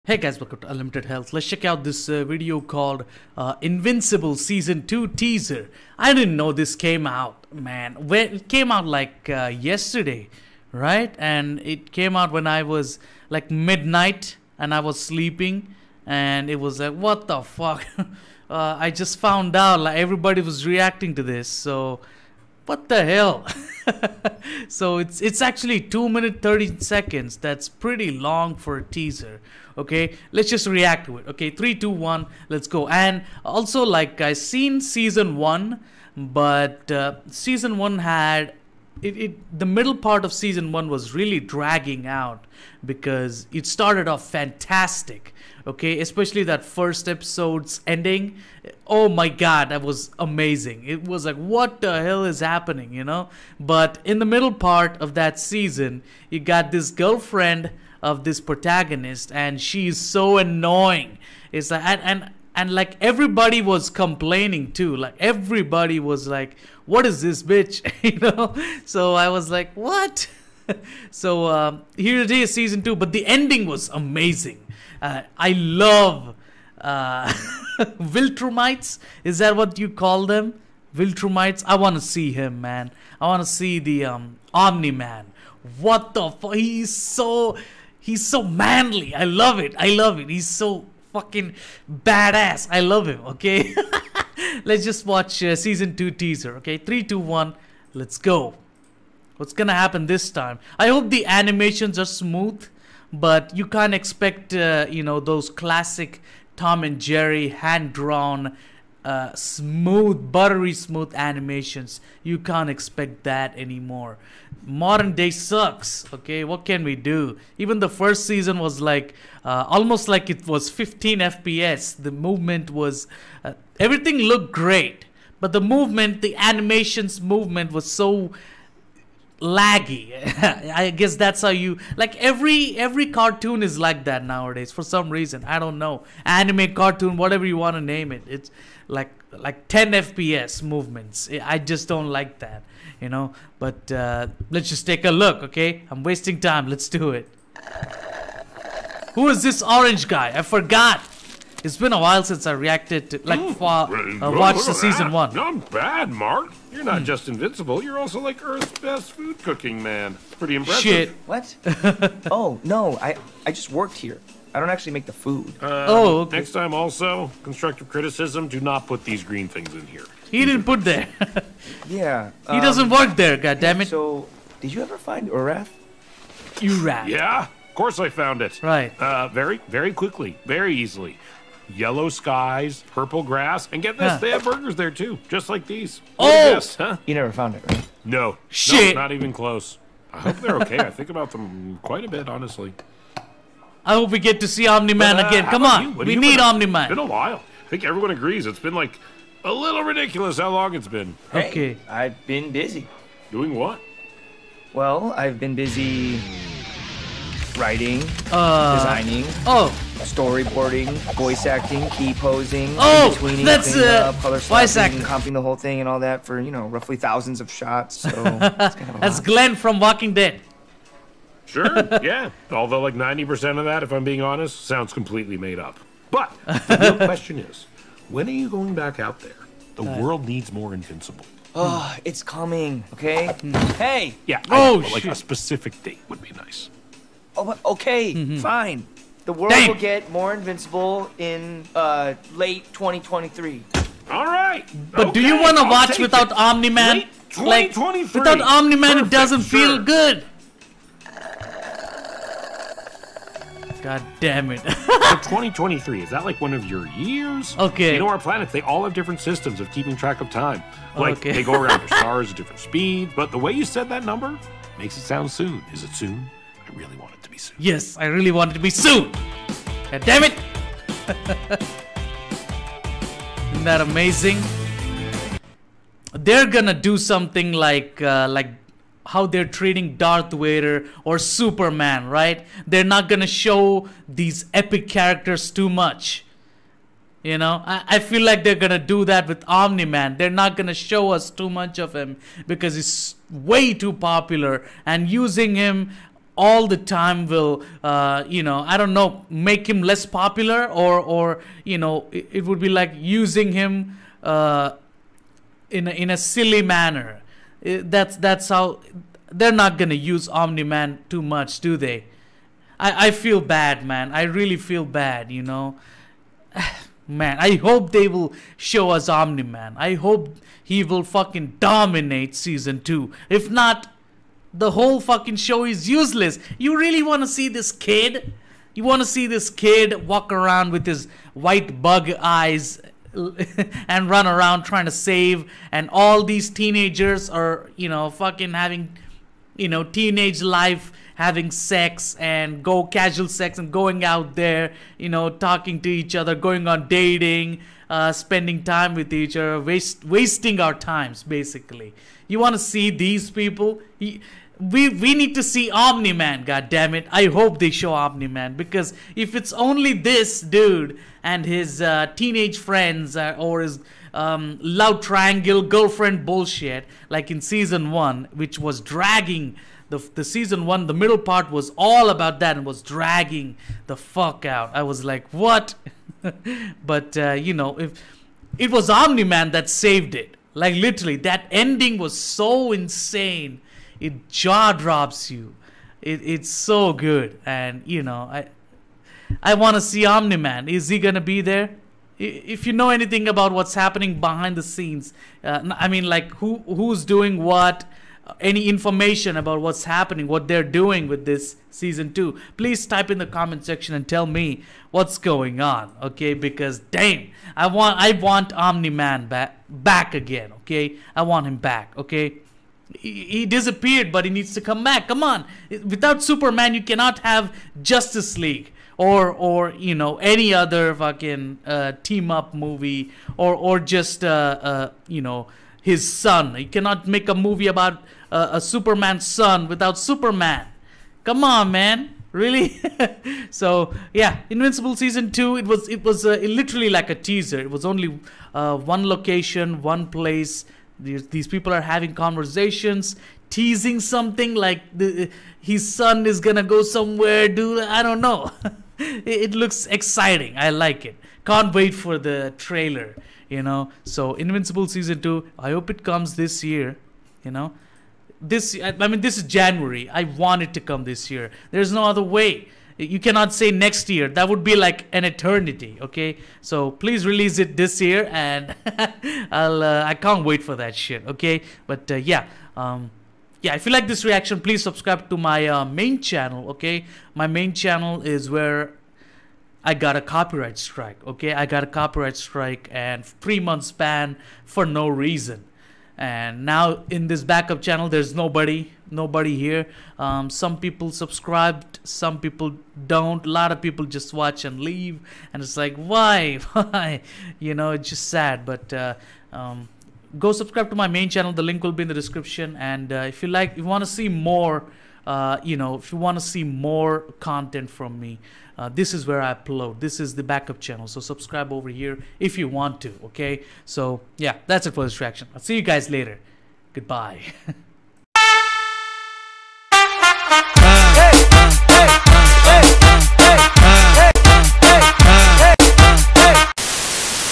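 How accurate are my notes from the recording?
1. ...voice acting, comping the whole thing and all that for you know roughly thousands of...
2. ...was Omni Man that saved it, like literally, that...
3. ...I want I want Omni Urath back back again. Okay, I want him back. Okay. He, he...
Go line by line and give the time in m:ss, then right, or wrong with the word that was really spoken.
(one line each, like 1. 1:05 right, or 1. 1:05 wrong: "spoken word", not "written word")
1. 3:34 right
2. 6:18 right
3. 6:47 wrong: "Man", not "Urath".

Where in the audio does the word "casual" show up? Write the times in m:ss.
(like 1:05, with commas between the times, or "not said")
5:42.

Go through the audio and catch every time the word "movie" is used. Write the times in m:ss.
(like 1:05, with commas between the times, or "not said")
7:02, 7:07.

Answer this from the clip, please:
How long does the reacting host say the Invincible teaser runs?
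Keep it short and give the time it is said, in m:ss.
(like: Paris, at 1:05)
2 minutes 30 seconds, at 0:25.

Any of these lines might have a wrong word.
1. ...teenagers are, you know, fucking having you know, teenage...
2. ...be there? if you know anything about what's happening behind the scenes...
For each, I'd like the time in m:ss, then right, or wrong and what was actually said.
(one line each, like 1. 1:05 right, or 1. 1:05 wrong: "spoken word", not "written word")
1. 5:36 right
2. 6:31 right.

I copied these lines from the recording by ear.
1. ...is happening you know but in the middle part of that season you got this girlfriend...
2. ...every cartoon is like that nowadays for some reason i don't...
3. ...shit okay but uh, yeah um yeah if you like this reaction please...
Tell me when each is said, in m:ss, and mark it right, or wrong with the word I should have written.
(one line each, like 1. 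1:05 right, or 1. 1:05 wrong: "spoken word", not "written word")
1. 0:52 right
2. 2:12 right
3. 7:50 right.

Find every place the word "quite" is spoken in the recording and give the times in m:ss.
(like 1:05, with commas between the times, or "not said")
3:11.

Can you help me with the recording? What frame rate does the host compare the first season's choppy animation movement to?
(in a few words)
15 FPS.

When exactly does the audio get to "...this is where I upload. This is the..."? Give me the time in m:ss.
8:28.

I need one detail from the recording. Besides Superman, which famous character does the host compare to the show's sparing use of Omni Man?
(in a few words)
Darth Vader.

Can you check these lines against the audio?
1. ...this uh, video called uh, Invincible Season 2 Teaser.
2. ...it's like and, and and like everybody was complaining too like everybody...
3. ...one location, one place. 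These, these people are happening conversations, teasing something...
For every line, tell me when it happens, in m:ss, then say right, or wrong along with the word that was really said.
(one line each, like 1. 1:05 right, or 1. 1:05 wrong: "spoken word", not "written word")
1. 0:01 right
2. 1:01 right
3. 7:18 wrong: "having", not "happening".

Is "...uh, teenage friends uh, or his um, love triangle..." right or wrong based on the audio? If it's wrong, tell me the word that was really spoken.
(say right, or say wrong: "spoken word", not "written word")
right.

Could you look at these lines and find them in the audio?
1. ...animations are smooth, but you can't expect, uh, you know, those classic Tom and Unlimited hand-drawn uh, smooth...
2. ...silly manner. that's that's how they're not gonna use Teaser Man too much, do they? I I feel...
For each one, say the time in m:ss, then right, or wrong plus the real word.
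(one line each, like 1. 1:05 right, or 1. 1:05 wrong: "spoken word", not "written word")
1. 1:41 wrong: "Jerry", not "Unlimited"
2. 5:06 wrong: "Omni", not "Teaser".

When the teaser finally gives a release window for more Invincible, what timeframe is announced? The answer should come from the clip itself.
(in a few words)
Late 2023.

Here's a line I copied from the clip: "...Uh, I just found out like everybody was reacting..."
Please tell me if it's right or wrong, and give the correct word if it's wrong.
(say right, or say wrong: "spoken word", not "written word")
right.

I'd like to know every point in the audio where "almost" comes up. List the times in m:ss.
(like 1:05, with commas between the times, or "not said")
1:59.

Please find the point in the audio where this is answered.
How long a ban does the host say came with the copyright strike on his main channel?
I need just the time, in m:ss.
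8:03.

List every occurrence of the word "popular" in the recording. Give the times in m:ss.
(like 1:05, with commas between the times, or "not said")
4:53, 5:00.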